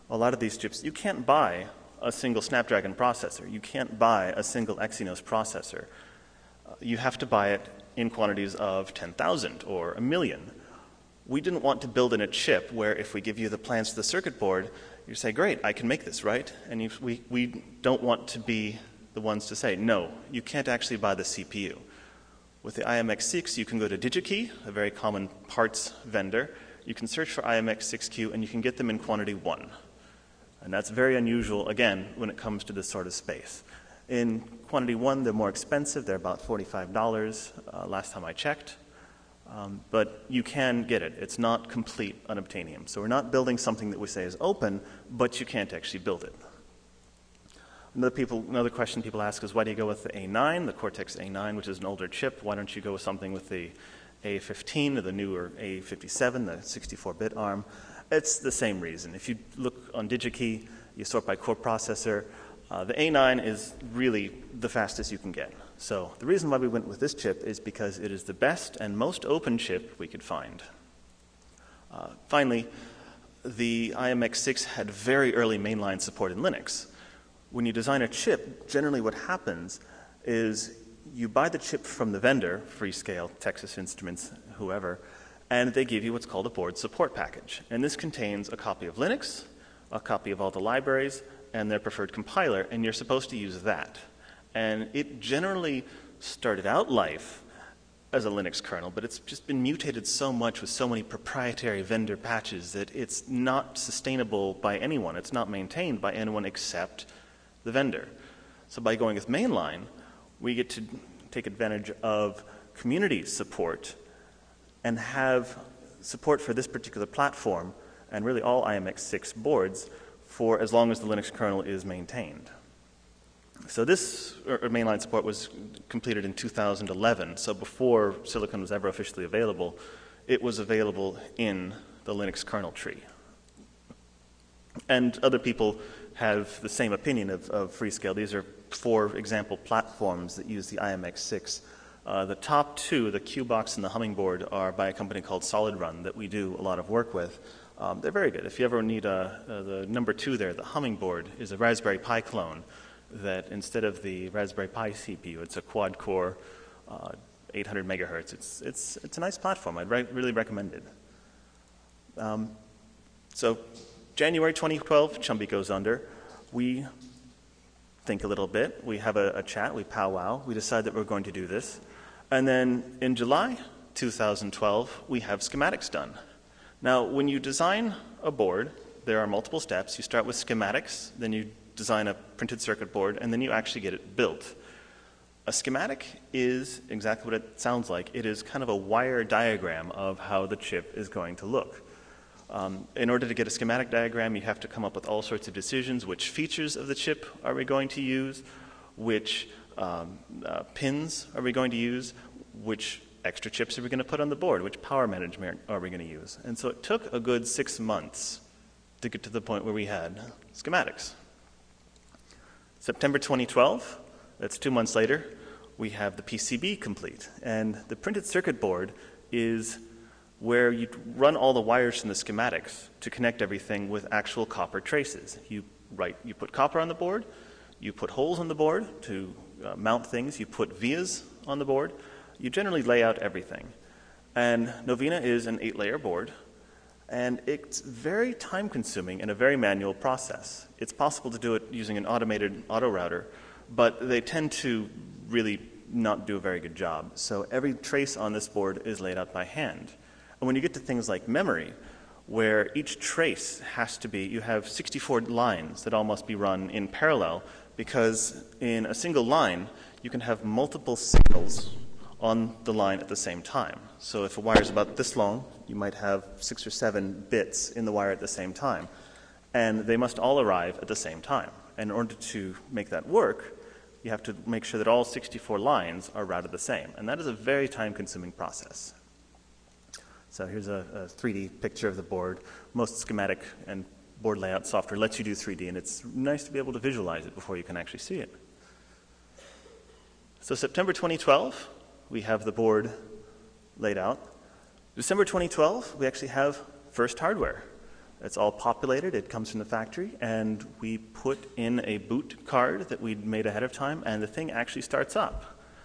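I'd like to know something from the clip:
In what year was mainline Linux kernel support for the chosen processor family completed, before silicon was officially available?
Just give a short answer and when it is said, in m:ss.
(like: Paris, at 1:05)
2011, at 2:06.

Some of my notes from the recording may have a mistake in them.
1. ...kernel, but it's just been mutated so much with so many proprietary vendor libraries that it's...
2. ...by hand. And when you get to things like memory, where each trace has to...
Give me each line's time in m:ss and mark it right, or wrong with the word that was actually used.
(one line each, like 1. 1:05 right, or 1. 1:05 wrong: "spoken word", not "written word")
1. 1:38 wrong: "patches", not "libraries"
2. 4:09 right.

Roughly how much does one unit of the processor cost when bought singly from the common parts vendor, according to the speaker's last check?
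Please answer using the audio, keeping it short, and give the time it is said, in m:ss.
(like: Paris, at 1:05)
$45, at 0:36.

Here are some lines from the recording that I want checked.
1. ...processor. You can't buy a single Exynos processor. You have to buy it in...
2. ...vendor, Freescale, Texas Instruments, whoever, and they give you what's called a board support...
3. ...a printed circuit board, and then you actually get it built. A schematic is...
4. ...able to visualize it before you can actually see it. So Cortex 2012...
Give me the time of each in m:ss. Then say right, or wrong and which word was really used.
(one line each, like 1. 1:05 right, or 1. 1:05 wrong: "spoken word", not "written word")
1. 0:02 right
2. 1:22 right
3. 3:02 right
4. 4:46 wrong: "September", not "Cortex".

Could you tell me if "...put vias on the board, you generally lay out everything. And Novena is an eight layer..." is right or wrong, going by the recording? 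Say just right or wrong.
right.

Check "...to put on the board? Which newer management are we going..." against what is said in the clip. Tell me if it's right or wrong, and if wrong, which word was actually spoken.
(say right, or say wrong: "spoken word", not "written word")
wrong: "power", not "newer".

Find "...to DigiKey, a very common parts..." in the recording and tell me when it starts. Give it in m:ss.
0:23.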